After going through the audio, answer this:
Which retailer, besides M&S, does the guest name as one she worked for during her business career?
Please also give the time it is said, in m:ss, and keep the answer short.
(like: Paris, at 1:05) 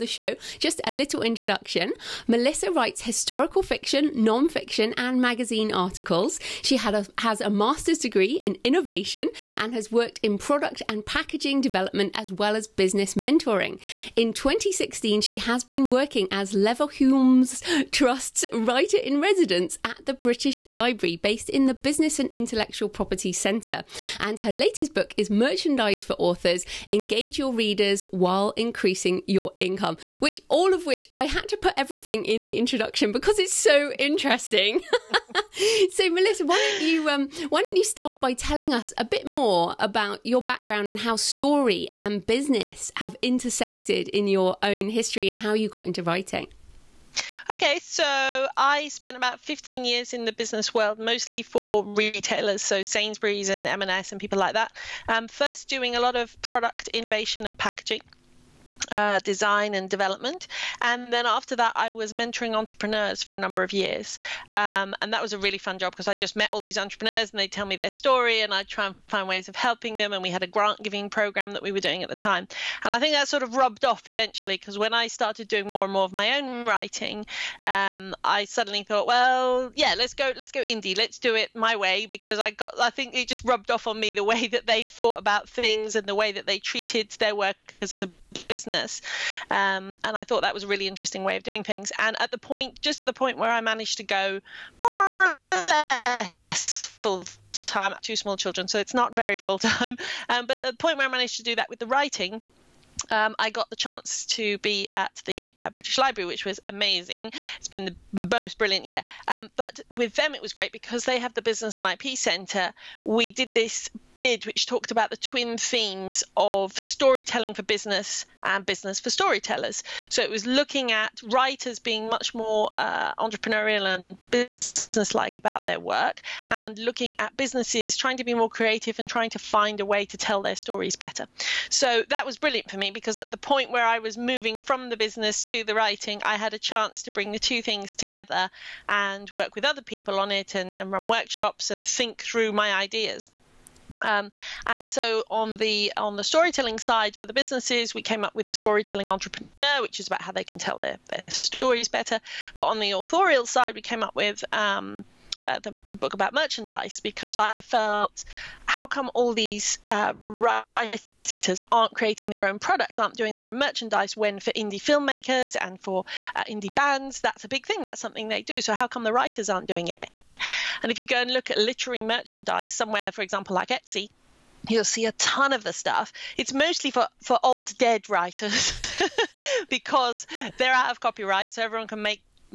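Sainsbury's, at 0:52.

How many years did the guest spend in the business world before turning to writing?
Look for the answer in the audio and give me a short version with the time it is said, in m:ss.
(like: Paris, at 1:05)
15 years, at 0:49.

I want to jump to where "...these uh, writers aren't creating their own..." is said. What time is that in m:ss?
2:39.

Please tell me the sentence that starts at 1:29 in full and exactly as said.
Um, and I thought that was a really interesting way of doing things.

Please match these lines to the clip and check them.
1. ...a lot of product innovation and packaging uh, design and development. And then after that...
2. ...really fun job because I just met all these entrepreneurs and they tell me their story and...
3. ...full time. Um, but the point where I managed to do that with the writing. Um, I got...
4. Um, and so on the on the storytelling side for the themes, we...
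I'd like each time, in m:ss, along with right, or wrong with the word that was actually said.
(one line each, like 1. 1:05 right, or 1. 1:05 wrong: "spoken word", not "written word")
1. 0:55 right
2. 1:05 right
3. 1:39 right
4. 2:24 wrong: "businesses", not "themes".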